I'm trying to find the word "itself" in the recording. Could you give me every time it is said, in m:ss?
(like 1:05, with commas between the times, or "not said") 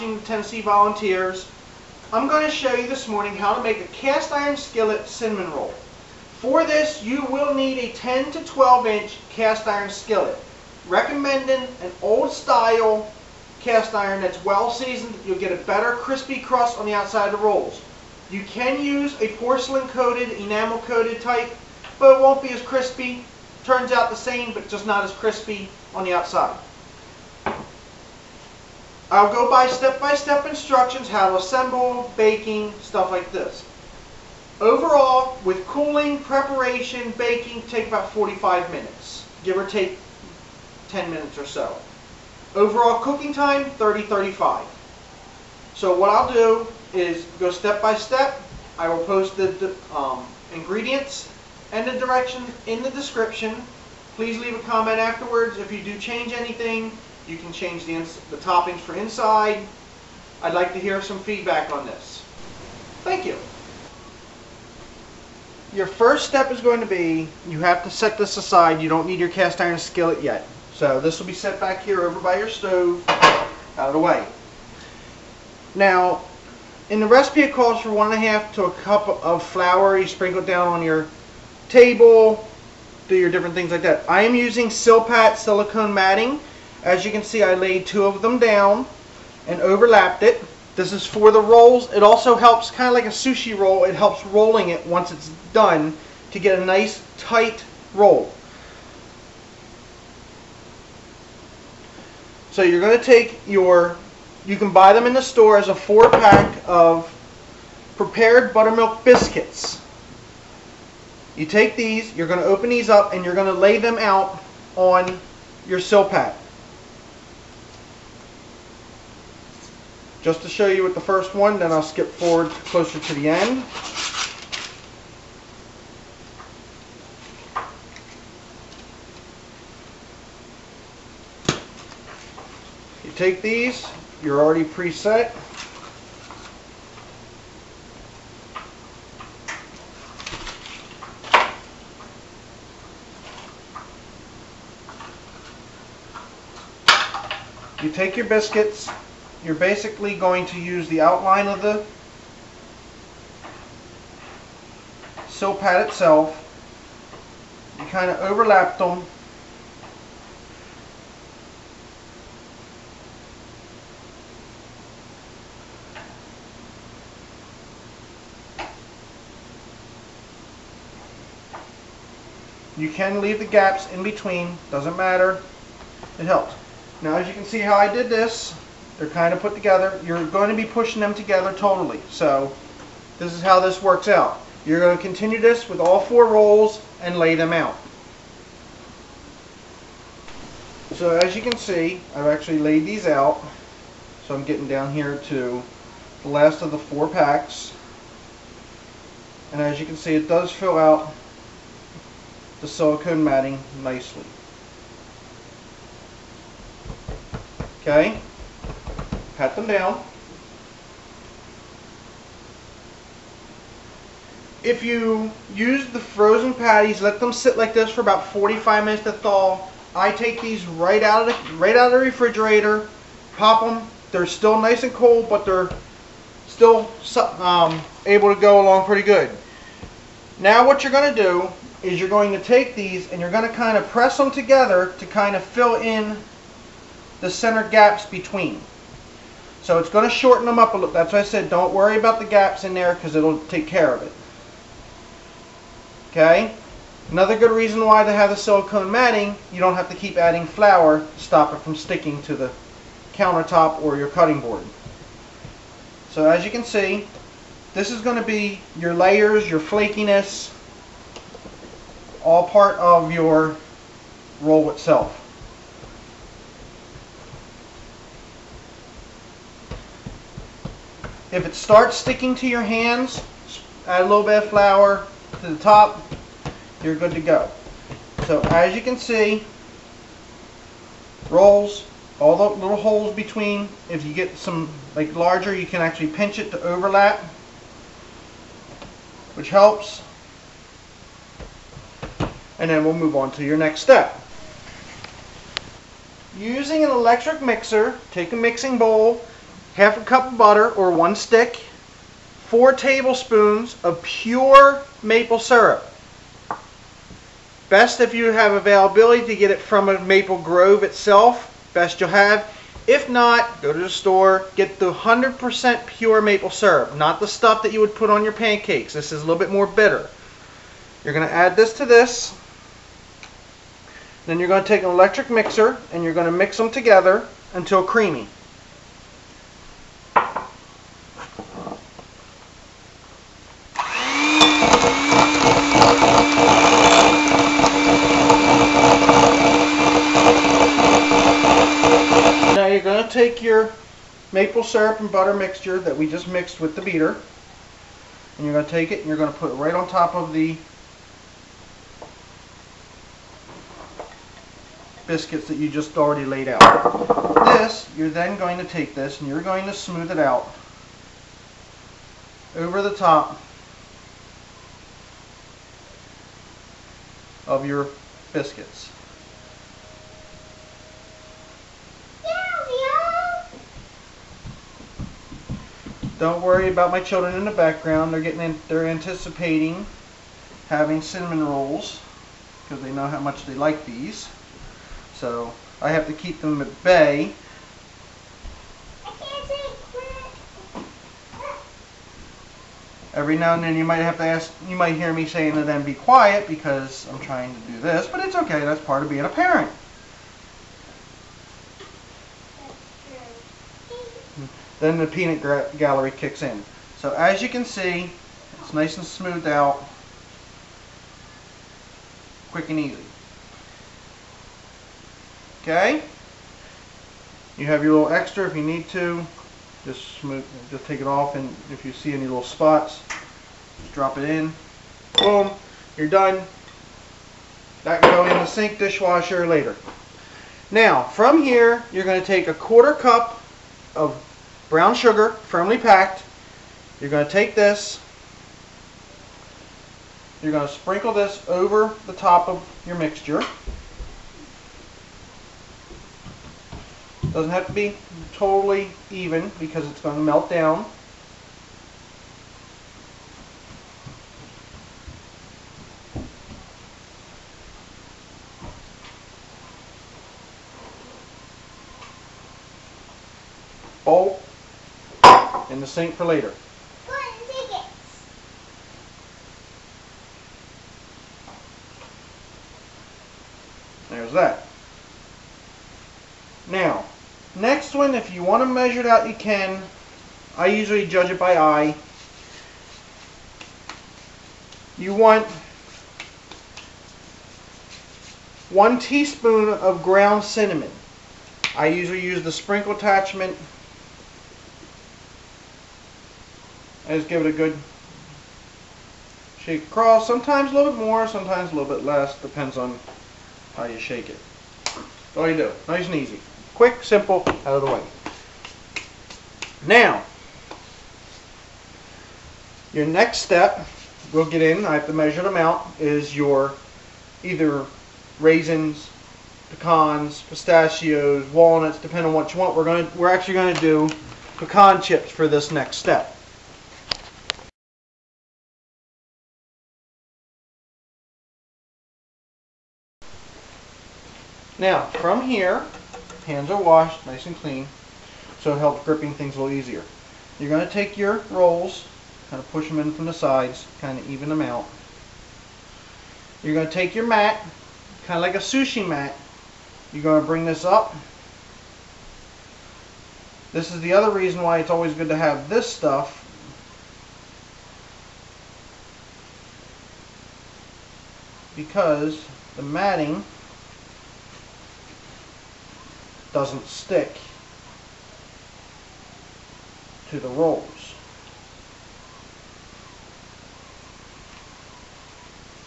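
2:35, 4:24, 5:10.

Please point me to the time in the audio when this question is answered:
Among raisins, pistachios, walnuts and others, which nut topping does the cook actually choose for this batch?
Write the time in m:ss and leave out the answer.
8:44.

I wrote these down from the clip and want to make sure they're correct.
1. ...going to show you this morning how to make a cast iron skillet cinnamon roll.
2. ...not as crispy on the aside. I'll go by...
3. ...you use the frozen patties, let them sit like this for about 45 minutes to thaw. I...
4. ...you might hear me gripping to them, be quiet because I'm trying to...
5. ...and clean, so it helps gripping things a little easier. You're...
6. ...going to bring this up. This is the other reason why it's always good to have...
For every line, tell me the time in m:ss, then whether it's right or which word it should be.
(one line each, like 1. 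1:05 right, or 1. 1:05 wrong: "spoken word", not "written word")
1. 0:02 right
2. 0:24 wrong: "outside", not "aside"
3. 3:34 right
4. 6:34 wrong: "saying", not "gripping"
5. 8:57 right
6. 9:10 right.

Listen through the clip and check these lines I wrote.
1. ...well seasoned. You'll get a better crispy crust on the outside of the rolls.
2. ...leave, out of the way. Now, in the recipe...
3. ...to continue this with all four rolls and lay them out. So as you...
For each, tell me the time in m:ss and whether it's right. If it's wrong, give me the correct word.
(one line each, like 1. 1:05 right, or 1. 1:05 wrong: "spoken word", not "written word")
1. 0:14 right
2. 1:12 wrong: "stove", not "leave"
3. 3:04 right.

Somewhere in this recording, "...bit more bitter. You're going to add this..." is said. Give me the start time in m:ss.
5:19.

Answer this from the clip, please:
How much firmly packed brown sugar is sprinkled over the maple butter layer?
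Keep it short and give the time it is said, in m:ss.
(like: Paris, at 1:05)
1/4 cup, at 7:12.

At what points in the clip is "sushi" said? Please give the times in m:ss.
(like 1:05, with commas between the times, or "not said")
1:33, 9:08.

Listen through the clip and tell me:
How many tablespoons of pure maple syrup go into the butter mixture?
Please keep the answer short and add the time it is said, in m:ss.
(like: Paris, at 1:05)
4, at 5:02.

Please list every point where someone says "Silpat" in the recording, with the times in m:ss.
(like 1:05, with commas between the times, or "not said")
1:24, 1:55, 2:35.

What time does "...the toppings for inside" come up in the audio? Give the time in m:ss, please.
0:58.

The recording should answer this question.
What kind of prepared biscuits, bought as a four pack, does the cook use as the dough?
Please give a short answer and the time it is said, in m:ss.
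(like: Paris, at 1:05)
buttermilk biscuits, at 1:48.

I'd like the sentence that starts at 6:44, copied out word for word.
Then the peanut gallery kicks in.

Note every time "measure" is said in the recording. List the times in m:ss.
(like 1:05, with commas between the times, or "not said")
7:58, 8:35.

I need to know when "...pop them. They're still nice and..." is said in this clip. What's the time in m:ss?
3:43.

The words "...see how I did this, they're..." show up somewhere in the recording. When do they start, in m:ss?
2:57.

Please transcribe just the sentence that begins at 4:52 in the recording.
And then we'll move on to your next step.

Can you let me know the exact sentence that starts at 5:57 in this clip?
This, you're then going to take this and you're going to smooth it out over the top of your biscuits.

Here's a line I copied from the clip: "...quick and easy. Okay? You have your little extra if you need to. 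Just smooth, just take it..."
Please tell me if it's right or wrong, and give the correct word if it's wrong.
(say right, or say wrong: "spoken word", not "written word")
right.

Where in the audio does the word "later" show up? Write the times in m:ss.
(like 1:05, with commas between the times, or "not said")
7:09, 7:46.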